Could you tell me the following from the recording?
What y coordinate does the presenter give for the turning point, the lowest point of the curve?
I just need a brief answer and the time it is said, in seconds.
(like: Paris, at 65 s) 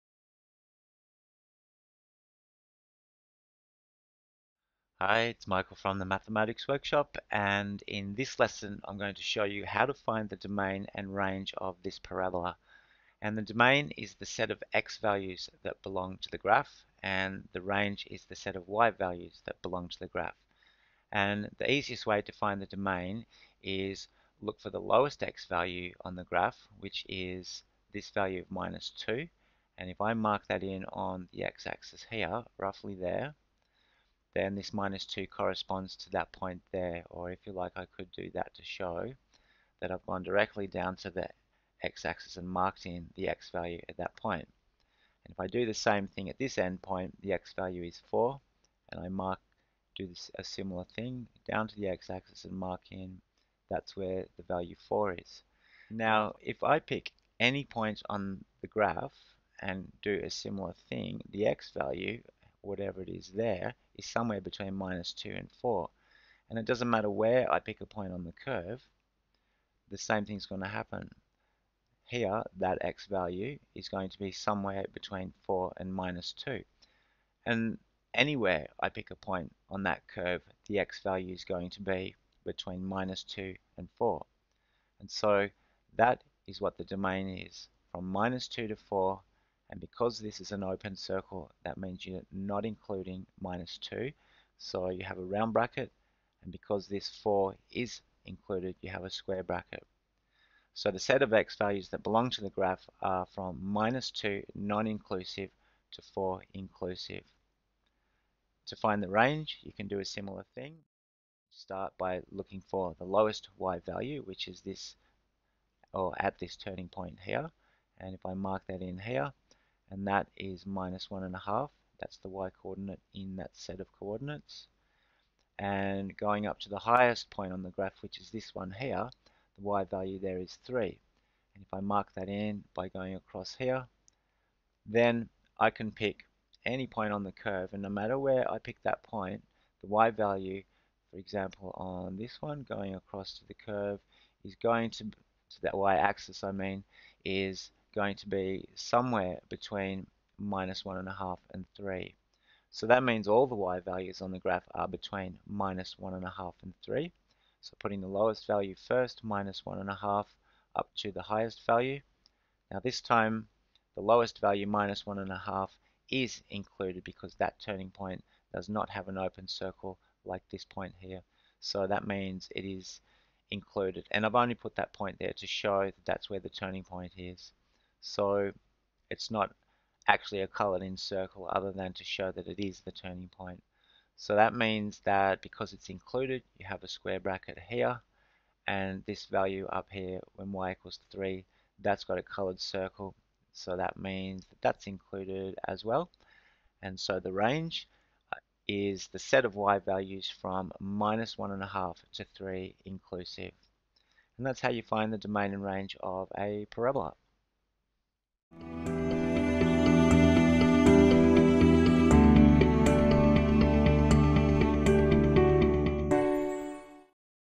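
-1.5, at 120 s.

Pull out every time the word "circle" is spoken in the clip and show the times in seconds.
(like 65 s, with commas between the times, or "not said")
90 s, 169 s, 180 s, 192 s.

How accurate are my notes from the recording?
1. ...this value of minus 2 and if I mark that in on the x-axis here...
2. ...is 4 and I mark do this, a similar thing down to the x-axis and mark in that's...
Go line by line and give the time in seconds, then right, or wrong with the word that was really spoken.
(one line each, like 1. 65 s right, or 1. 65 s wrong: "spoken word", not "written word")
1. 27 s right
2. 47 s right.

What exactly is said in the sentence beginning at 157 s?
So putting the lowest value first, minus 1.5, up to the highest value.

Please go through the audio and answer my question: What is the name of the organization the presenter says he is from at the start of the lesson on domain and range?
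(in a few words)
Mathematics Workshop.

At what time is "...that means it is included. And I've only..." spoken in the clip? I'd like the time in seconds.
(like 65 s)
171 s.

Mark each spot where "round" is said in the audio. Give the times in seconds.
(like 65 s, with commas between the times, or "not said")
95 s.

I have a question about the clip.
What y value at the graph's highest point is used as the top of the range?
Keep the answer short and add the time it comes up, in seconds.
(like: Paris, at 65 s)
3, at 129 s.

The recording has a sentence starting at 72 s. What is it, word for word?
Here, that x value is going to be somewhere between 4 and minus 2.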